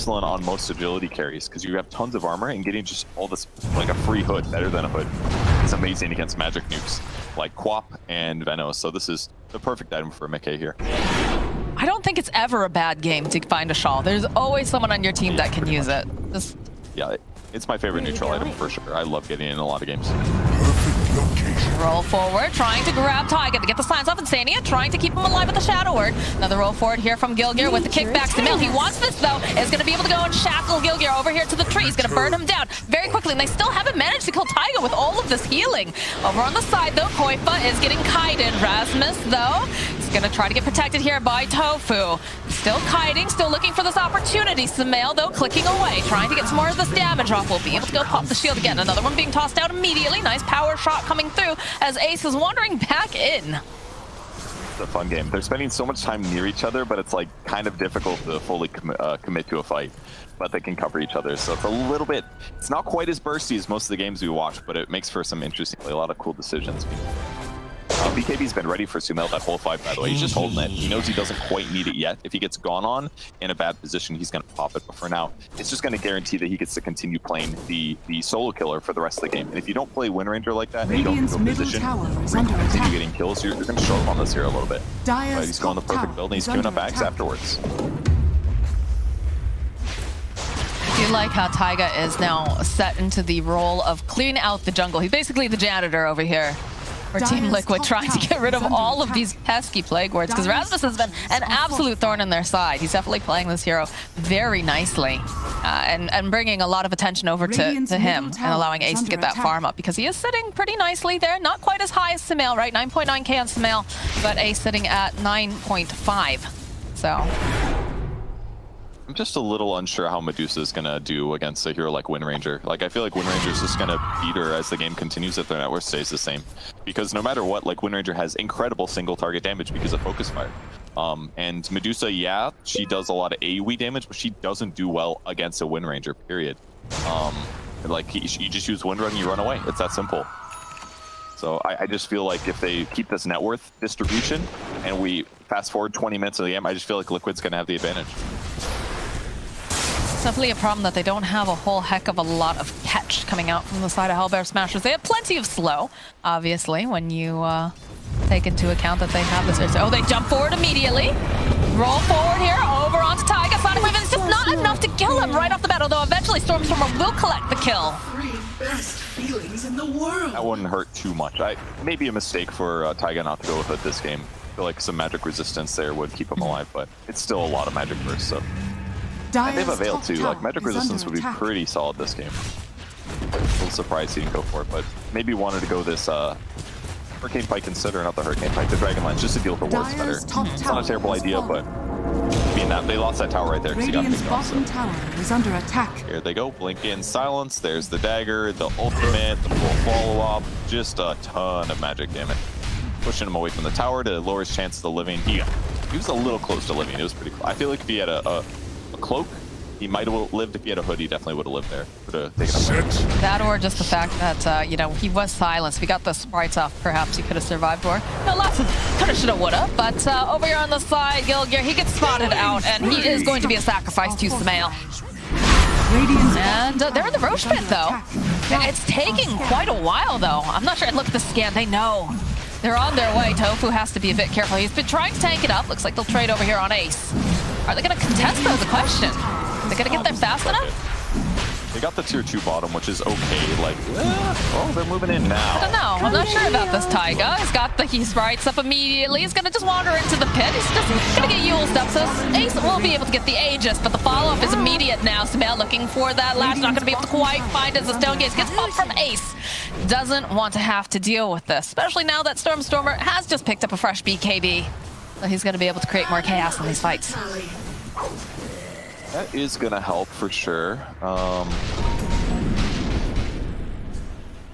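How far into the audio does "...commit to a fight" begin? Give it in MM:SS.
00:59.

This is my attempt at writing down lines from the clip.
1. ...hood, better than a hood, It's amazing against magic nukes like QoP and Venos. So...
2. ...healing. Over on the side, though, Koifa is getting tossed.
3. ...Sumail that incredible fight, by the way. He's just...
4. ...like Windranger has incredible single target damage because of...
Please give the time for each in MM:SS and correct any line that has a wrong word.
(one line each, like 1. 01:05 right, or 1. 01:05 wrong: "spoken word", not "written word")
1. 00:04 right
2. 00:35 wrong: "kited", not "tossed"
3. 01:08 wrong: "whole", not "incredible"
4. 02:07 right.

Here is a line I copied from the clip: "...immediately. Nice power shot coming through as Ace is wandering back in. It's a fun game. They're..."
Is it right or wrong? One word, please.
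right.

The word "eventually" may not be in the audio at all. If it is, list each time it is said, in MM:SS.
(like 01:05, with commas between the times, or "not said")
02:46.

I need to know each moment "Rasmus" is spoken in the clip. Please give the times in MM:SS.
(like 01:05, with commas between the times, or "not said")
00:38, 01:40.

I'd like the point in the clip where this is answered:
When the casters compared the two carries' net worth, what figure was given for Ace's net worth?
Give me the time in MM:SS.
01:55.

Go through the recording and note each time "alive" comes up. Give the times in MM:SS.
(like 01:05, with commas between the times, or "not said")
00:25, 02:56.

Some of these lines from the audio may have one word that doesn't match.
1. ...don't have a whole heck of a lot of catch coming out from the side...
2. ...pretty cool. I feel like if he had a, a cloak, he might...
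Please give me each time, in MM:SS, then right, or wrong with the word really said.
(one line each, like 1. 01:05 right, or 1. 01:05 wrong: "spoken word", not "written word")
1. 02:31 right
2. 03:27 right.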